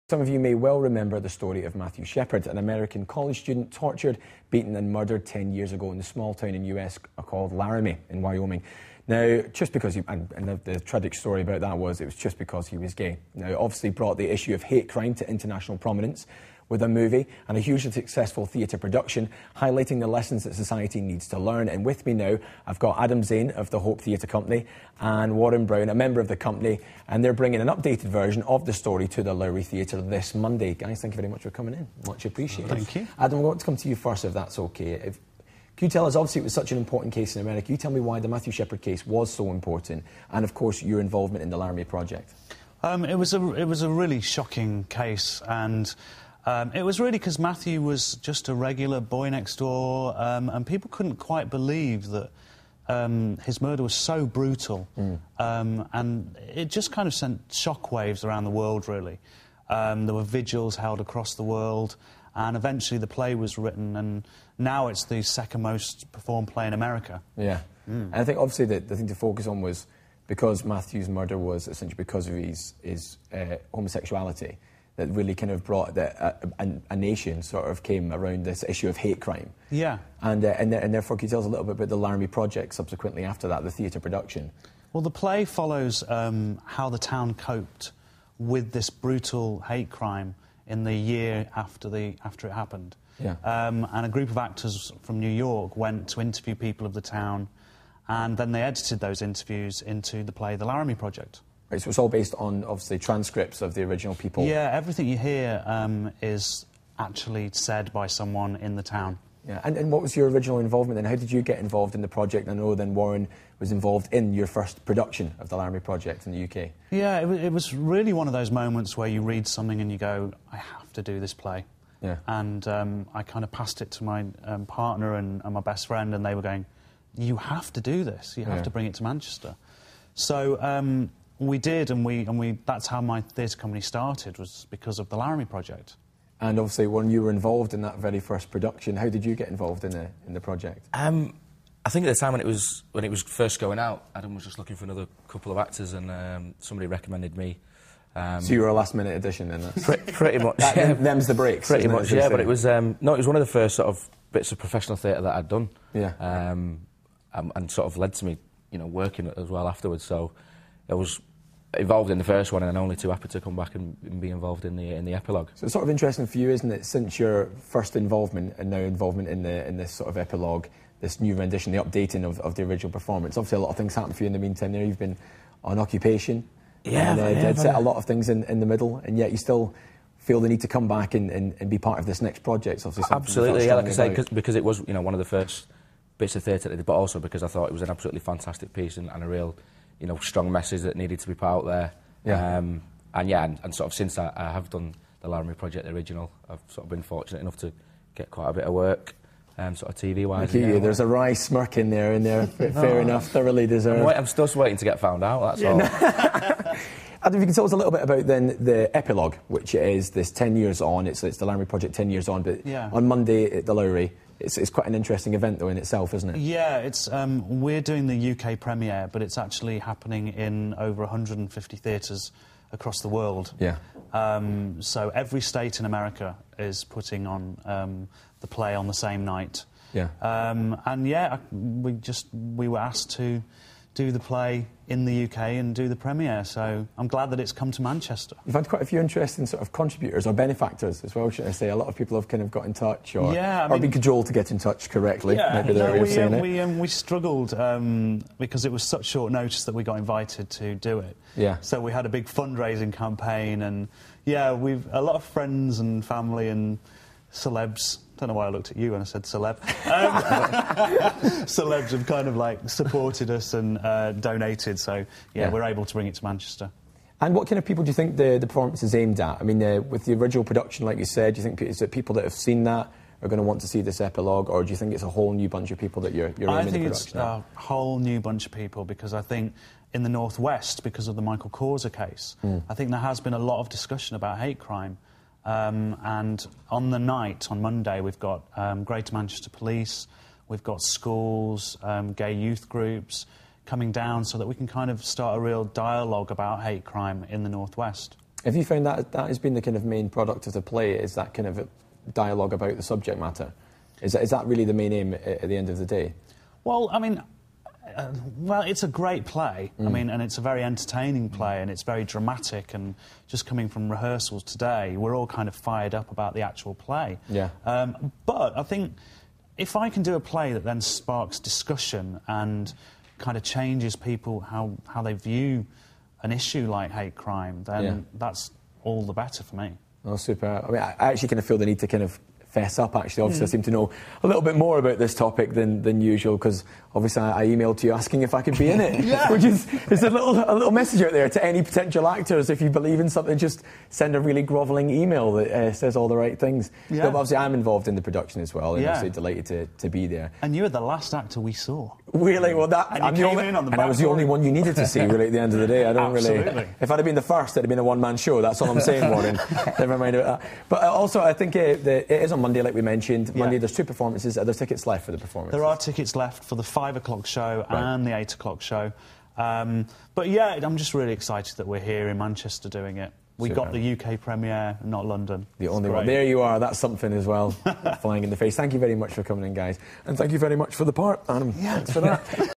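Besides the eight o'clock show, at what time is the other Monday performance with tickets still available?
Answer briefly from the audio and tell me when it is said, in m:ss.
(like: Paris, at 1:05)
5 o'clock, at 6:06.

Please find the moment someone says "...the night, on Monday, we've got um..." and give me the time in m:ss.
4:46.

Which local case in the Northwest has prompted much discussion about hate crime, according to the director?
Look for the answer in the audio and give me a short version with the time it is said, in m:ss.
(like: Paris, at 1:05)
Michael Causer case, at 4:41.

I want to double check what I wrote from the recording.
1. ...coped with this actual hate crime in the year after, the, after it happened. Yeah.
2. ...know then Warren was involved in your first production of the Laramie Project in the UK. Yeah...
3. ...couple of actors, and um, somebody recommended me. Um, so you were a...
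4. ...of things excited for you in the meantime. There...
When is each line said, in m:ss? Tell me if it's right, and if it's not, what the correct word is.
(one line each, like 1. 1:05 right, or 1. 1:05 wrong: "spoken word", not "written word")
1. 1:27 wrong: "brutal", not "actual"
2. 1:52 right
3. 2:25 right
4. 2:53 wrong: "happened", not "excited".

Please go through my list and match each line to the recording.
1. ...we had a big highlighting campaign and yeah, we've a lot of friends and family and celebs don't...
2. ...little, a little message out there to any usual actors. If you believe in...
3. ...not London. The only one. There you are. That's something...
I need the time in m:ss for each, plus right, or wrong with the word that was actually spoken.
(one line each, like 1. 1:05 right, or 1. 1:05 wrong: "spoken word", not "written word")
1. 4:11 wrong: "fundraising", not "highlighting"
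2. 5:40 wrong: "potential", not "usual"
3. 6:14 right.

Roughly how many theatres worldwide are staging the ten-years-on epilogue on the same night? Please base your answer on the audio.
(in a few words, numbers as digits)
Over 150.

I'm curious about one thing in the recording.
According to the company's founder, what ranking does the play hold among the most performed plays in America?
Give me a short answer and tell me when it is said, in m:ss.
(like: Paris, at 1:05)
Second, at 1:05.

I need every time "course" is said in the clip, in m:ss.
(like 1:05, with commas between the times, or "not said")
0:40.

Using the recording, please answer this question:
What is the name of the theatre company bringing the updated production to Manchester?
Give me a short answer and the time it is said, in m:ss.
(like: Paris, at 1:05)
Hope Theatre Company, at 0:23.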